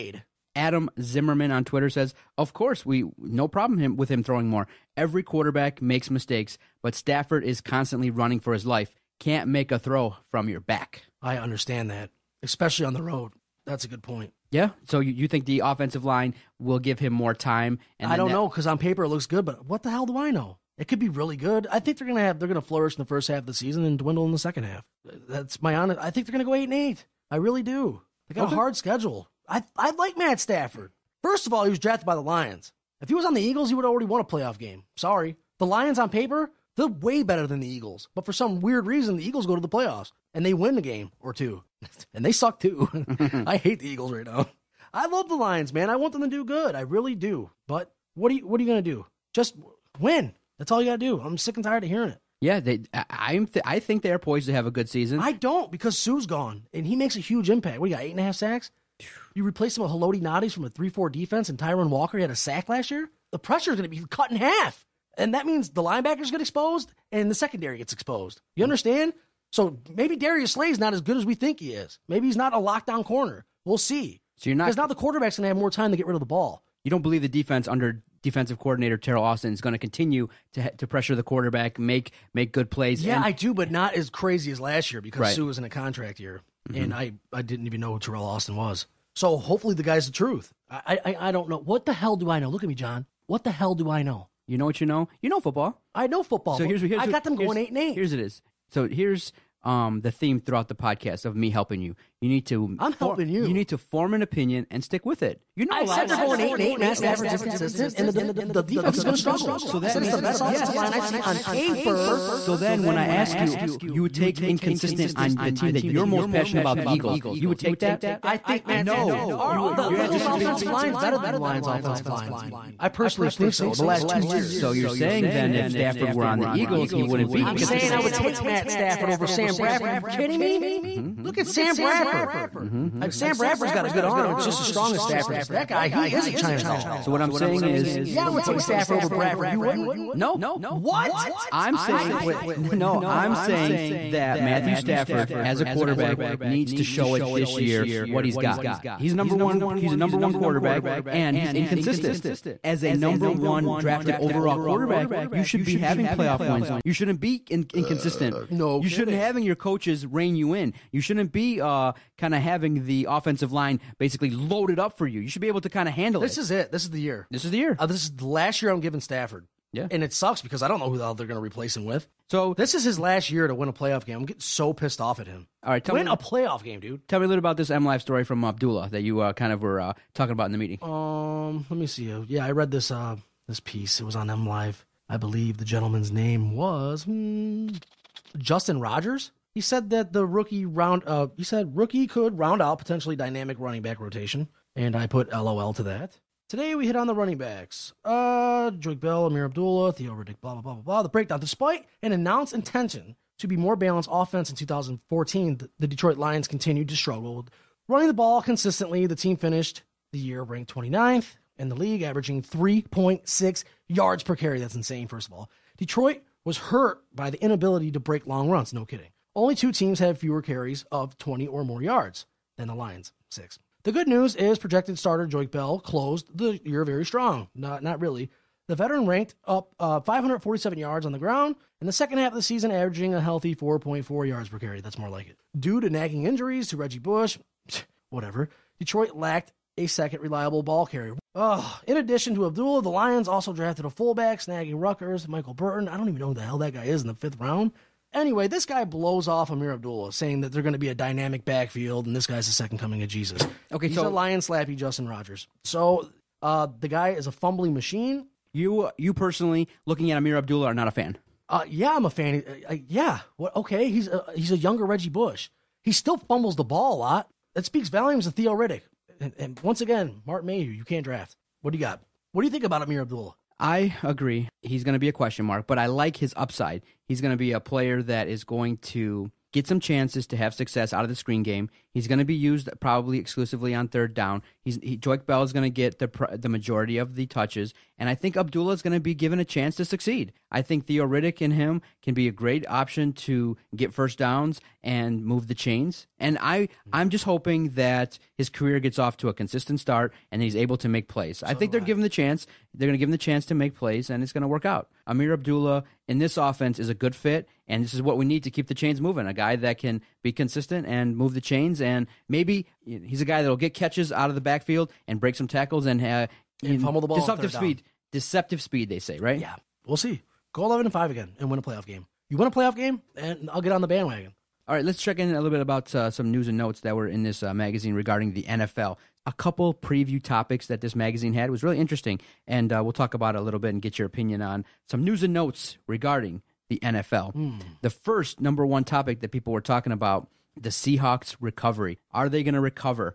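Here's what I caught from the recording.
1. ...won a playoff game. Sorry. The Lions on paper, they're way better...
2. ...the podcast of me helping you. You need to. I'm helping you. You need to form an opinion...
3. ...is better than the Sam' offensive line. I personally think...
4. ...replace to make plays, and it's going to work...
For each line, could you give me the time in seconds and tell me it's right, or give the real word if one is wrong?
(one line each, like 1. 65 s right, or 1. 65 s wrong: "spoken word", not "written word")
1. 34 s right
2. 100 s right
3. 120 s wrong: "Lions", not "Sam"
4. 303 s wrong: "chance", not "replace".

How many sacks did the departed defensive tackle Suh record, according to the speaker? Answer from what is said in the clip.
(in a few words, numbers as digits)
8.5.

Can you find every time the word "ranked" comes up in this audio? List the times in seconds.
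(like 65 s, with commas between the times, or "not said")
210 s, 229 s.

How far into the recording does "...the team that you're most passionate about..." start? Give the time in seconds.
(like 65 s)
115 s.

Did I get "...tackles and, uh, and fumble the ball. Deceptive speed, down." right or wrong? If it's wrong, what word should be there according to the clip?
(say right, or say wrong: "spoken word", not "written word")
right.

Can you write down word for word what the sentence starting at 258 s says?
You you personally looking at Amir Abdullah are not a fan.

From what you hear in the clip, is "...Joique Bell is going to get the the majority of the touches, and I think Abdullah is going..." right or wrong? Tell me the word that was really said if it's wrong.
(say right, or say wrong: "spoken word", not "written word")
right.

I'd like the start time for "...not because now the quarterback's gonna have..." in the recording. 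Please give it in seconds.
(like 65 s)
74 s.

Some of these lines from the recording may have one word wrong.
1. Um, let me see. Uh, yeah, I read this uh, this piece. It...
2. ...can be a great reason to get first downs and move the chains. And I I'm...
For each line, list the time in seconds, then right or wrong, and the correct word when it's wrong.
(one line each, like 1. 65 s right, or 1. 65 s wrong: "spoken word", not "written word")
1. 180 s right
2. 292 s wrong: "option", not "reason".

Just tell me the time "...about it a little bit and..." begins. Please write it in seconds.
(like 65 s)
333 s.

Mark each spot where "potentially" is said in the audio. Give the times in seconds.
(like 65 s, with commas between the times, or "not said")
192 s.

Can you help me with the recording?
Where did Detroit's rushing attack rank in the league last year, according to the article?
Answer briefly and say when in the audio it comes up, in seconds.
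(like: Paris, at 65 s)
29th, at 210 s.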